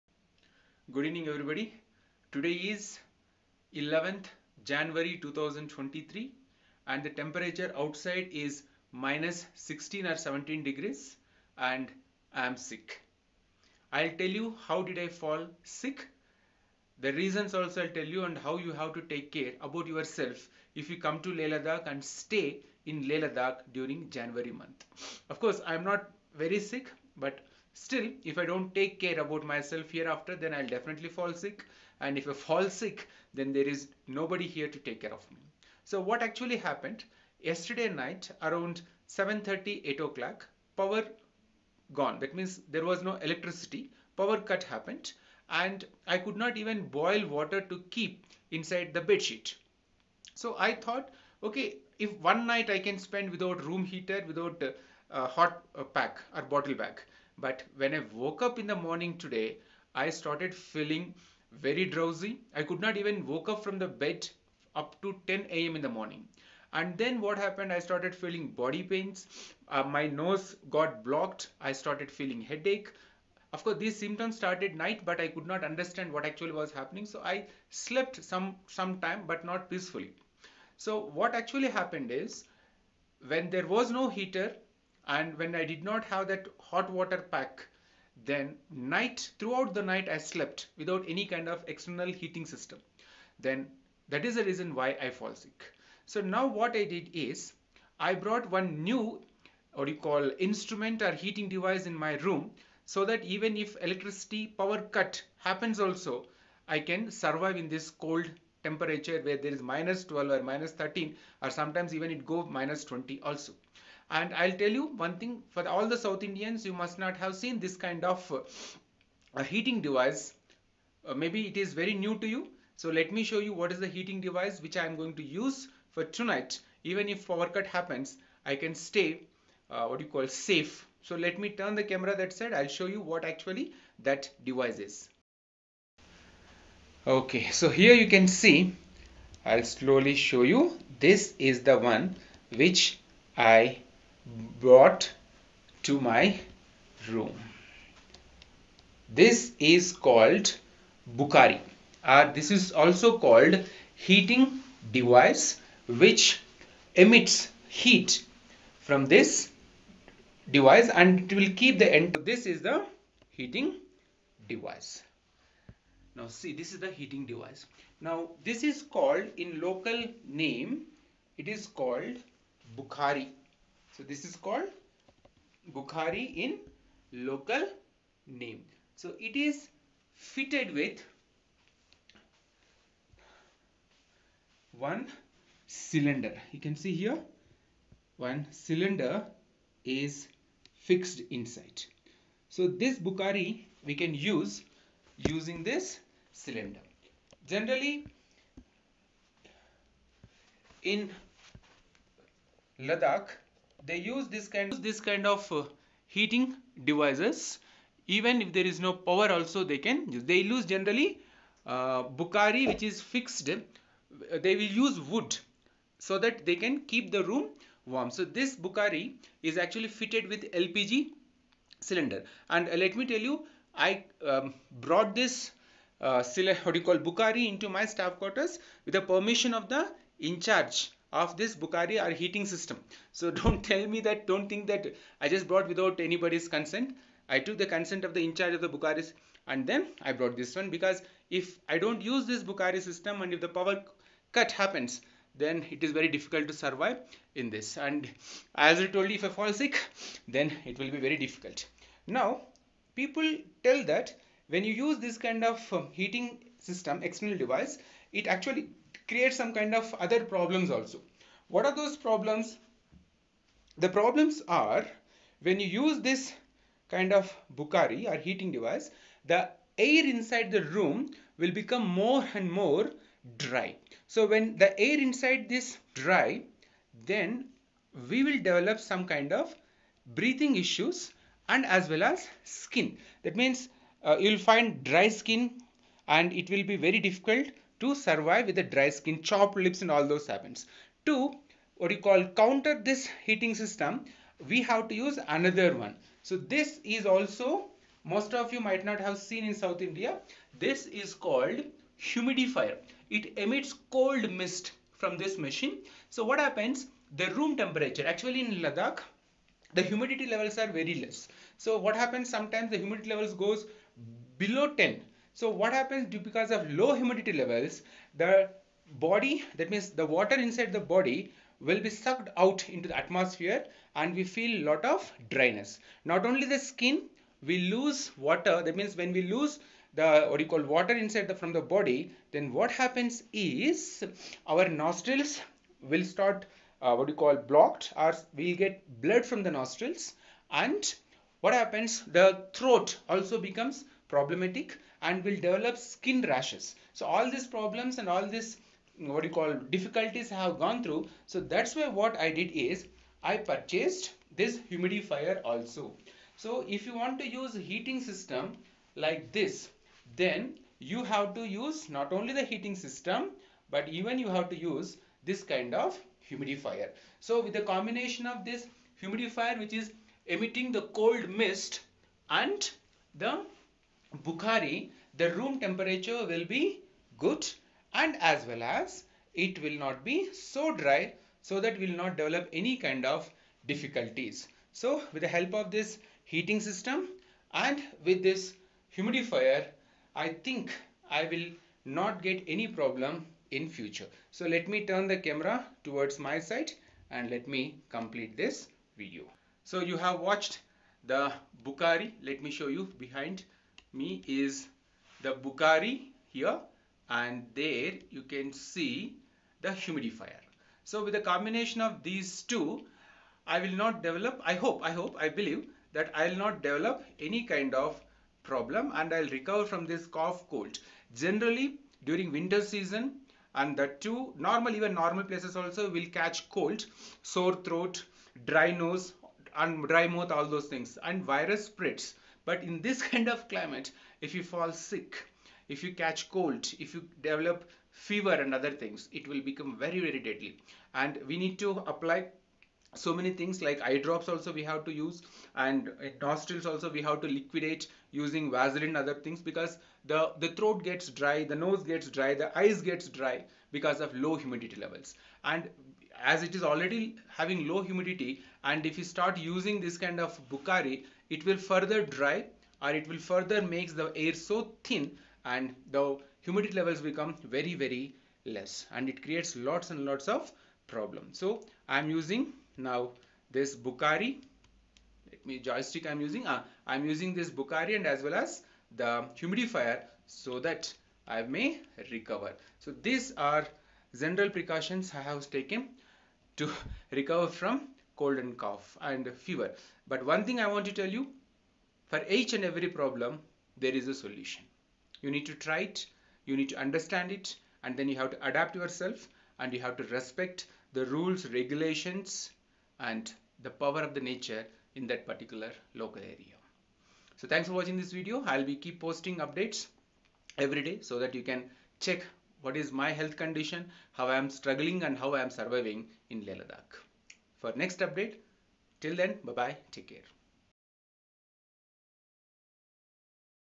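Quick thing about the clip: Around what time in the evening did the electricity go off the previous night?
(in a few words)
7.30.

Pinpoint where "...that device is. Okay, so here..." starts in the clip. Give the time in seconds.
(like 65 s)
133 s.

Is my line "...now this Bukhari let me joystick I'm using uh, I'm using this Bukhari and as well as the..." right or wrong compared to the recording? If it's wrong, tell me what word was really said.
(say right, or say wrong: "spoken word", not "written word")
right.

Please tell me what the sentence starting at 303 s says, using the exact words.
It emits cold mist from this machine.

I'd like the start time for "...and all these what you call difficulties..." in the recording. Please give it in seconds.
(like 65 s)
348 s.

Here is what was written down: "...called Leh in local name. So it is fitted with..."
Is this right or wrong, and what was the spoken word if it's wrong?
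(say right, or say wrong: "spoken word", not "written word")
wrong: "Bukhari", not "Leh".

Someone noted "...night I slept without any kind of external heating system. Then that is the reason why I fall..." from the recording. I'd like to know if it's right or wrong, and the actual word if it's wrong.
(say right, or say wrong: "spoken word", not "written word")
right.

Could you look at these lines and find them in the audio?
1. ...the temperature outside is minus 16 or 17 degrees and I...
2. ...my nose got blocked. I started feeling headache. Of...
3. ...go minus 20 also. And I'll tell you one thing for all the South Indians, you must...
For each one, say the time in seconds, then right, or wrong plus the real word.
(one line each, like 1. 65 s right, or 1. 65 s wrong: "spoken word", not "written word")
1. 7 s right
2. 69 s right
3. 112 s right.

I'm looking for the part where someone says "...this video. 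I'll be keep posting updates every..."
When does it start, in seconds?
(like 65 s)
507 s.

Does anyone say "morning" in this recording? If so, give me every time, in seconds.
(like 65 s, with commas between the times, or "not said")
58 s, 65 s.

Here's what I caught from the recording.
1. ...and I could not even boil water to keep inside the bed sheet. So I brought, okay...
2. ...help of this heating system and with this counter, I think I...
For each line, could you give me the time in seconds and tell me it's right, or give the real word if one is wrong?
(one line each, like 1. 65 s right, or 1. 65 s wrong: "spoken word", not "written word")
1. 45 s wrong: "thought", not "brought"
2. 385 s wrong: "humidifier", not "counter".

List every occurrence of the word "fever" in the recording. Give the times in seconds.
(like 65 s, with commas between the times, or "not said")
437 s, 489 s.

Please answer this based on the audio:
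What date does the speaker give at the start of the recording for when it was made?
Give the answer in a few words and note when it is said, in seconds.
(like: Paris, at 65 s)
11th January 2023, at 3 s.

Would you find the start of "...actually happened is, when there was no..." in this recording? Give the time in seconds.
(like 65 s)
81 s.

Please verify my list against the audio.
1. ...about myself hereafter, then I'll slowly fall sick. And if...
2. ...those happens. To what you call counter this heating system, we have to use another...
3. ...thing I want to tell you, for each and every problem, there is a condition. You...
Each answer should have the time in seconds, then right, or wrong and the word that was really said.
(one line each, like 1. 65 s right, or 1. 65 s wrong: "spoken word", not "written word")
1. 29 s wrong: "definitely", not "slowly"
2. 290 s right
3. 490 s wrong: "solution", not "condition".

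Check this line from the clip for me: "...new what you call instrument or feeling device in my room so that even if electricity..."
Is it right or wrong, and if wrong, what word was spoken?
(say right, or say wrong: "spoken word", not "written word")
wrong: "heating", not "feeling".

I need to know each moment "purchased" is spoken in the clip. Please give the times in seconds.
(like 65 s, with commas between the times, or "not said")
353 s.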